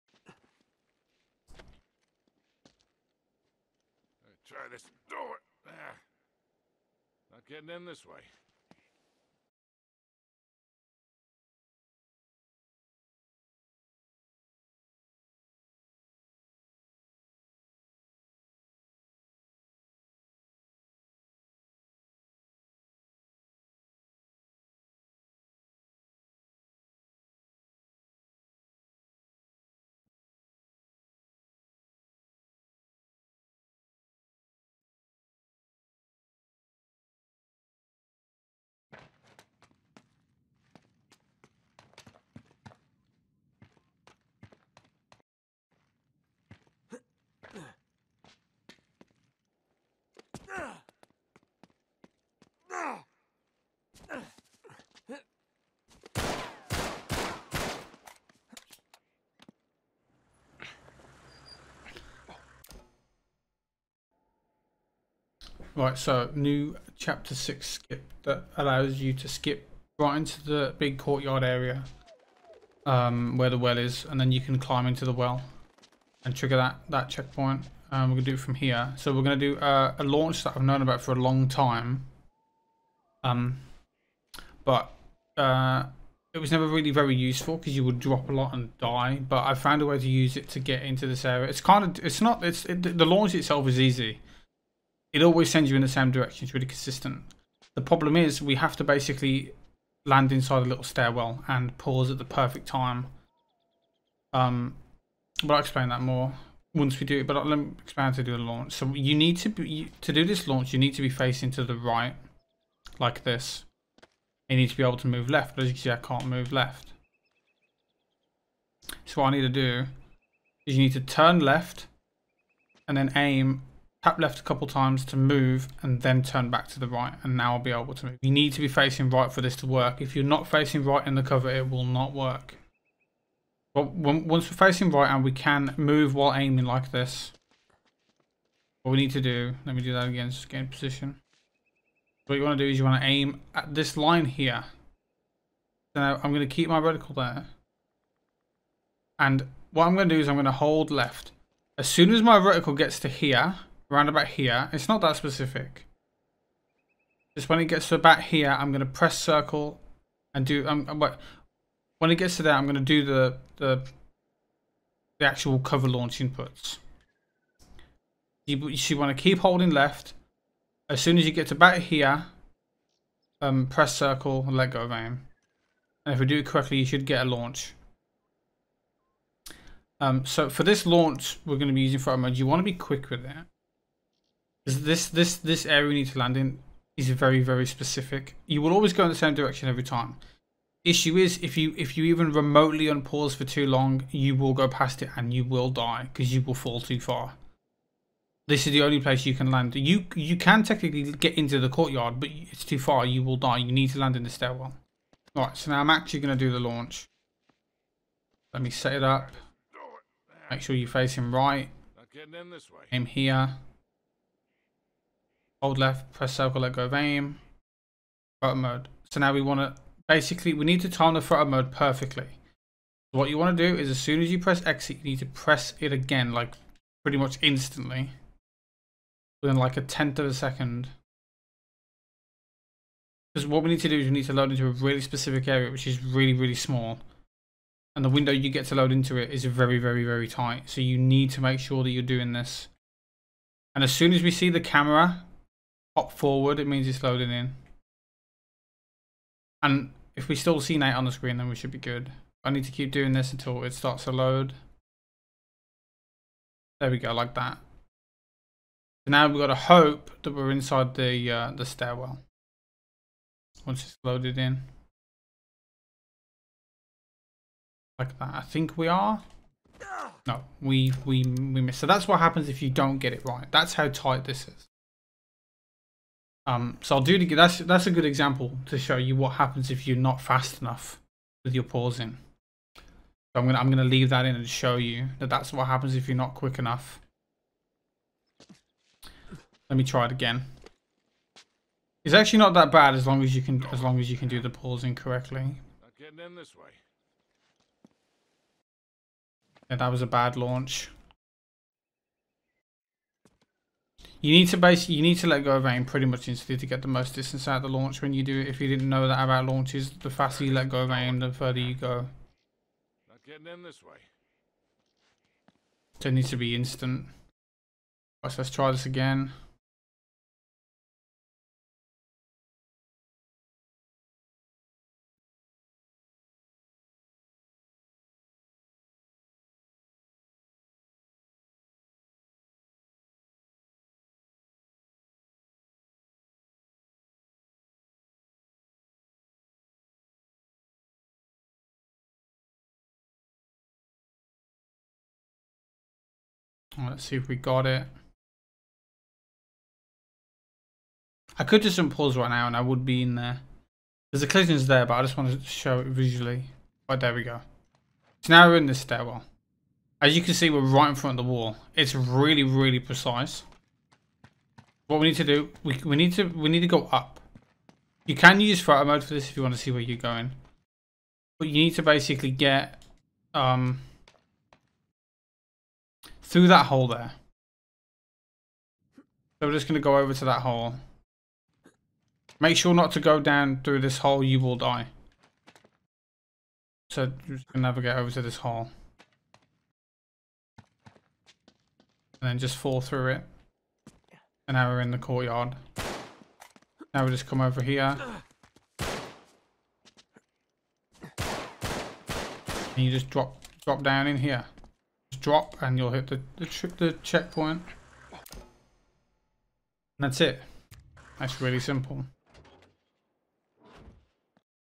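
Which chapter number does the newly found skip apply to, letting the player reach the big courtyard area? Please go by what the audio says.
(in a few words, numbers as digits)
6.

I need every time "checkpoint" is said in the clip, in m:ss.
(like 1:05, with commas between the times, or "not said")
1:17, 6:47.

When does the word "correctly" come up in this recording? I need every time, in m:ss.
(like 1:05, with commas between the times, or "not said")
2:56, 4:54.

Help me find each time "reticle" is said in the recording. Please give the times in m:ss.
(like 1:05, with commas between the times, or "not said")
2:26, 2:32.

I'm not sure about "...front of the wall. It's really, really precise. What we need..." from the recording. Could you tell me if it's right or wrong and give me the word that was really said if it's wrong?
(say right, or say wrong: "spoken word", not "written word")
right.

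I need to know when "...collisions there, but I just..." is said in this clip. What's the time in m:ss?
5:54.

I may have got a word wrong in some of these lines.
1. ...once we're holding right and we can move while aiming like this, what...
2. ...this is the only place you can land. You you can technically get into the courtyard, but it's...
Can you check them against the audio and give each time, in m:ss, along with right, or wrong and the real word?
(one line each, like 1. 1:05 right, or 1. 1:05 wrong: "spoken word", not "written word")
1. 2:13 wrong: "facing", not "holding"
2. 3:18 right.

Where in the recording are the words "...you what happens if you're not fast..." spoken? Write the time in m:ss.
4:38.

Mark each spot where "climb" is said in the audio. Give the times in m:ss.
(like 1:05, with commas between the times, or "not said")
1:14.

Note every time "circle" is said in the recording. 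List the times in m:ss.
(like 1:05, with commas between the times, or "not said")
2:39, 2:53, 3:36.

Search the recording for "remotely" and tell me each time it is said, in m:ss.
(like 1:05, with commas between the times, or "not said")
3:12.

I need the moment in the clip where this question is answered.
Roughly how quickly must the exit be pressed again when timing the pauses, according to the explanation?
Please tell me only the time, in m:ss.
3:49.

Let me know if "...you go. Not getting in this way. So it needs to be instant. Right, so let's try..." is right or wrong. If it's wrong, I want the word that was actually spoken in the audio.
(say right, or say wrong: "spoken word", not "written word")
right.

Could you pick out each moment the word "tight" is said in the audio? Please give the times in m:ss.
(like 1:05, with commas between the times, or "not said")
4:00, 4:33.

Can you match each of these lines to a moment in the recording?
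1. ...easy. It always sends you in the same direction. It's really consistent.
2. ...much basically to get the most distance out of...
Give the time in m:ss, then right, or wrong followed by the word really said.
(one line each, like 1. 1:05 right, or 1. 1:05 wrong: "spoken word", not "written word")
1. 1:33 right
2. 5:06 wrong: "instantly", not "basically".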